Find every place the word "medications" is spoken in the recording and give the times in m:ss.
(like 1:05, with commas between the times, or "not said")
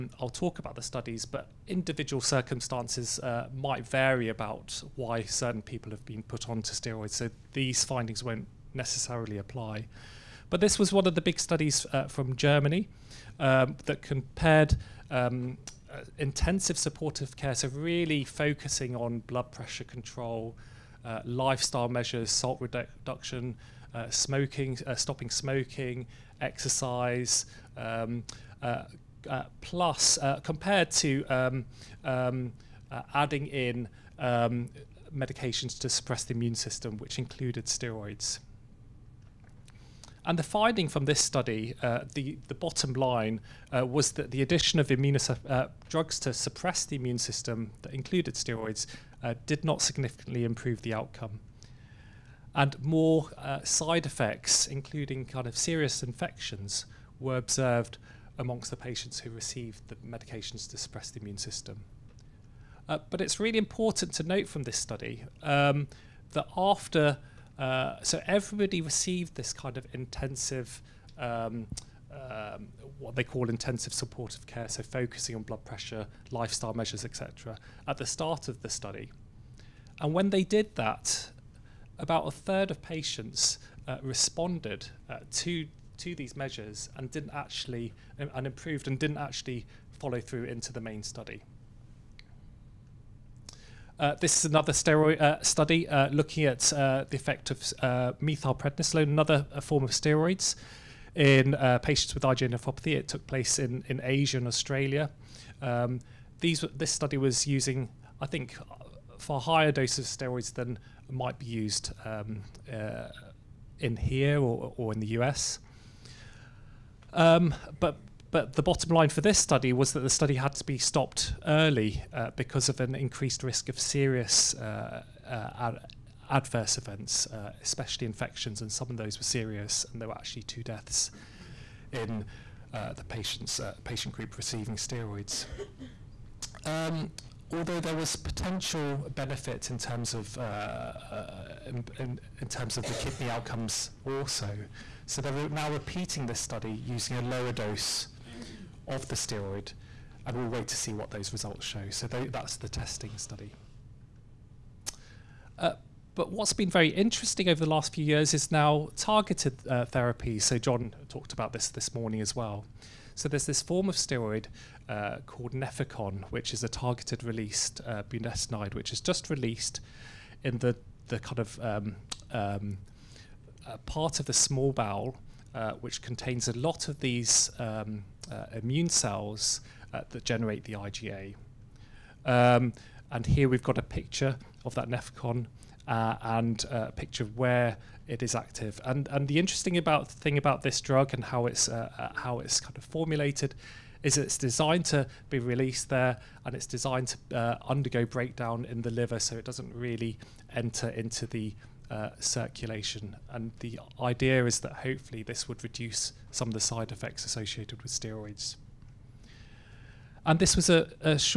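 0:35, 0:59.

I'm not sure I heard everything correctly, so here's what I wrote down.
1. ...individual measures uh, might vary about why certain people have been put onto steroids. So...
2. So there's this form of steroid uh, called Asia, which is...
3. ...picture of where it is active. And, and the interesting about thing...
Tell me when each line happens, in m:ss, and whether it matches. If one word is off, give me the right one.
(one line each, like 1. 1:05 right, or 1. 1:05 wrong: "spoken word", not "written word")
1. 0:01 wrong: "circumstances", not "measures"
2. 2:43 wrong: "Nefecon", not "Asia"
3. 3:06 right.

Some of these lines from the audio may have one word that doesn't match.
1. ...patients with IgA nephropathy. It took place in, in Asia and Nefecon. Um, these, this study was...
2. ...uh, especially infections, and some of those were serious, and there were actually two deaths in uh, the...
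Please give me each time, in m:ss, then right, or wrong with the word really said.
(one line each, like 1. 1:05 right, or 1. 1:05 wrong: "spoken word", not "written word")
1. 1:41 wrong: "Australia", not "Nefecon"
2. 2:07 right.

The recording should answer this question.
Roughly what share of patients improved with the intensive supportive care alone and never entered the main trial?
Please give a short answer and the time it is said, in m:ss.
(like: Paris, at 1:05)
a third, at 1:22.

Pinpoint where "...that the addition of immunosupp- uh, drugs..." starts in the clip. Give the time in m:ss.
0:44.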